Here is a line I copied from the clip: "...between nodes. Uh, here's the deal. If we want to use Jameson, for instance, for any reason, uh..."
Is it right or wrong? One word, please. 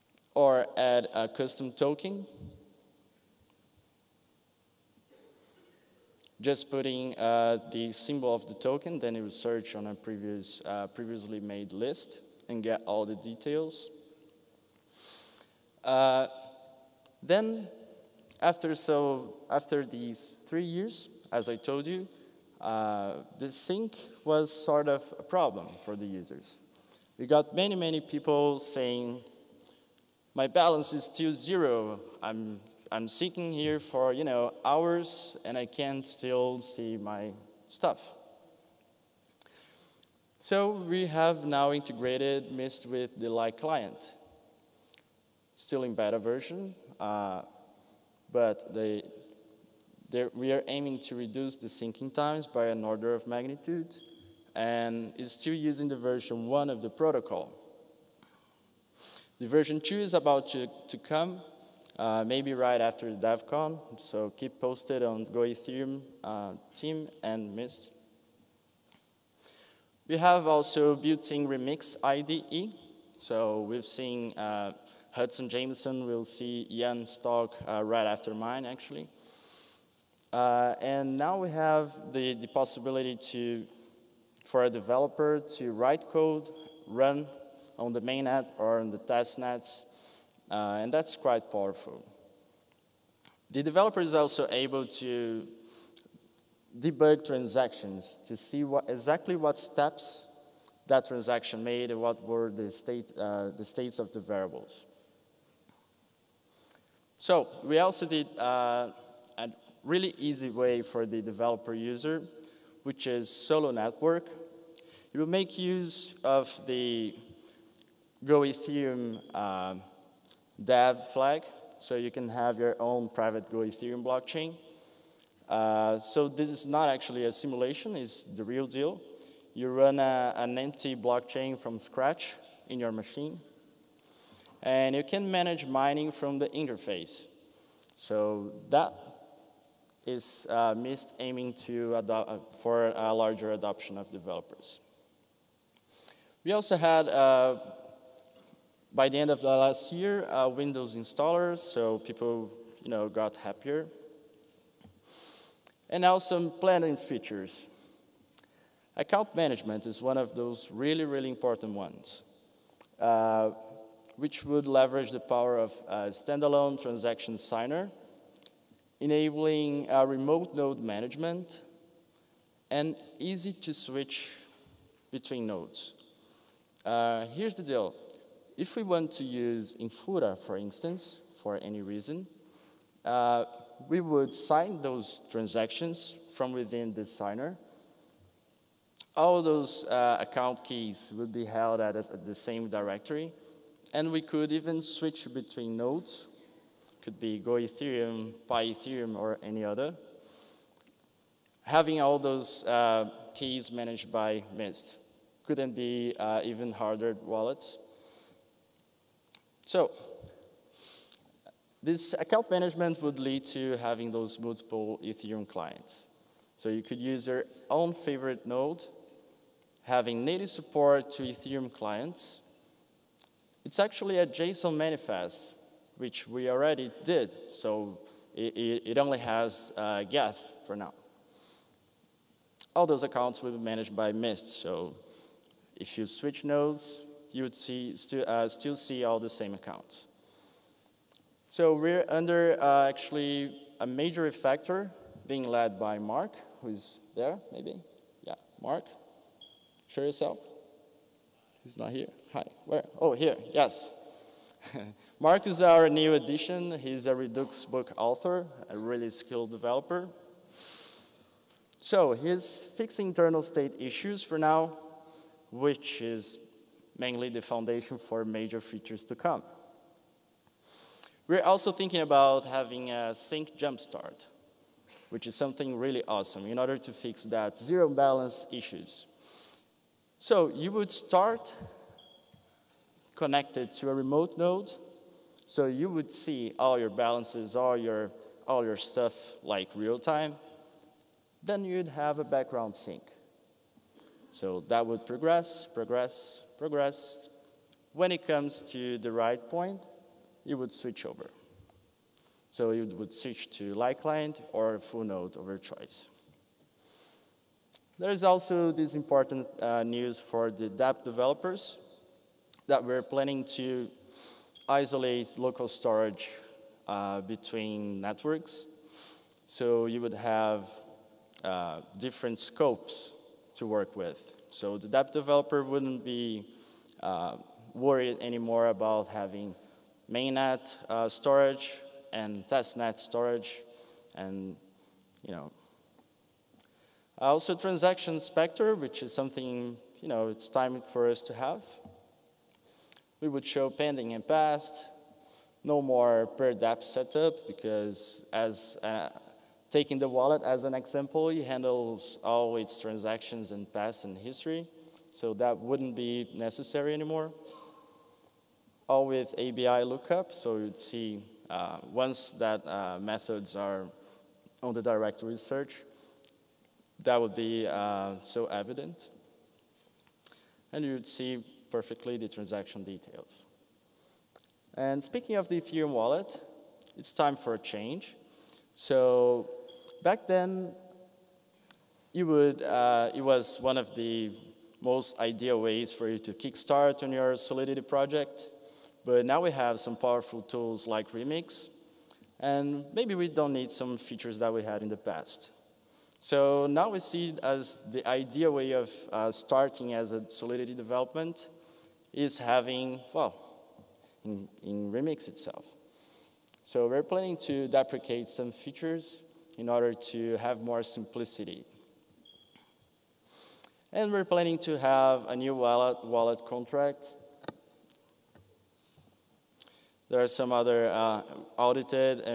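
wrong.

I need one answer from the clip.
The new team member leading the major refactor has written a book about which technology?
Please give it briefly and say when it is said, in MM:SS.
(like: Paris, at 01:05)
Redux, at 04:17.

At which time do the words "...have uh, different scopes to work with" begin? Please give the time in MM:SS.
05:20.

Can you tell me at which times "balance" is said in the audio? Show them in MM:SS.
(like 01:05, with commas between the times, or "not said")
00:30, 04:37, 04:46.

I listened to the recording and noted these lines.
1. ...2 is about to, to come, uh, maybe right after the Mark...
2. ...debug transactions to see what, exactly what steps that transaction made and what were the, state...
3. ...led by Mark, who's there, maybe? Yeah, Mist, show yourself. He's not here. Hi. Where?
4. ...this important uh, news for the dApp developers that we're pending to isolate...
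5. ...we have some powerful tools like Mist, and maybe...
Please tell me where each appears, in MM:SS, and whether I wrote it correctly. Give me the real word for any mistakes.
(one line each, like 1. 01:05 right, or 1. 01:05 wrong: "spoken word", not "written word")
1. 00:59 wrong: "DEVCON", not "Mark"
2. 01:36 right
3. 04:05 wrong: "Mark", not "Mist"
4. 05:08 wrong: "planning", not "pending"
5. 06:29 wrong: "Remix", not "Mist".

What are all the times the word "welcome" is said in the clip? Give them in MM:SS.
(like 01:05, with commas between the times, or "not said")
not said.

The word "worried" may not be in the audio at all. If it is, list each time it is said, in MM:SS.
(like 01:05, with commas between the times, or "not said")
05:27.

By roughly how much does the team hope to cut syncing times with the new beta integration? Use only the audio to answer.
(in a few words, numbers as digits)
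an order of magnitude.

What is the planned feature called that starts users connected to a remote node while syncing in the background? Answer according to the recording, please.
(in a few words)
sync jumpstart.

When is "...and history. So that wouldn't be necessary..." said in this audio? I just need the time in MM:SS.
05:54.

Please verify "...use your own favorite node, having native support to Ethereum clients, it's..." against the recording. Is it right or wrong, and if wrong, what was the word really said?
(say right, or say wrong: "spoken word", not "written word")
right.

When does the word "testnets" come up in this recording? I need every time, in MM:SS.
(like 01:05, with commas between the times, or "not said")
01:28, 05:32.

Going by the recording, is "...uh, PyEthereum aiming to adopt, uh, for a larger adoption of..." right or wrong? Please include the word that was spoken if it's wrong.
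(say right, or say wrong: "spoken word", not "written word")
wrong: "MIST", not "PyEthereum".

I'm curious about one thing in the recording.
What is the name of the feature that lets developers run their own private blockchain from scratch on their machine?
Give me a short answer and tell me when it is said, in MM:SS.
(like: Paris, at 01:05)
Solo Network, at 01:53.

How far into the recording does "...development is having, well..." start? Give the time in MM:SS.
06:40.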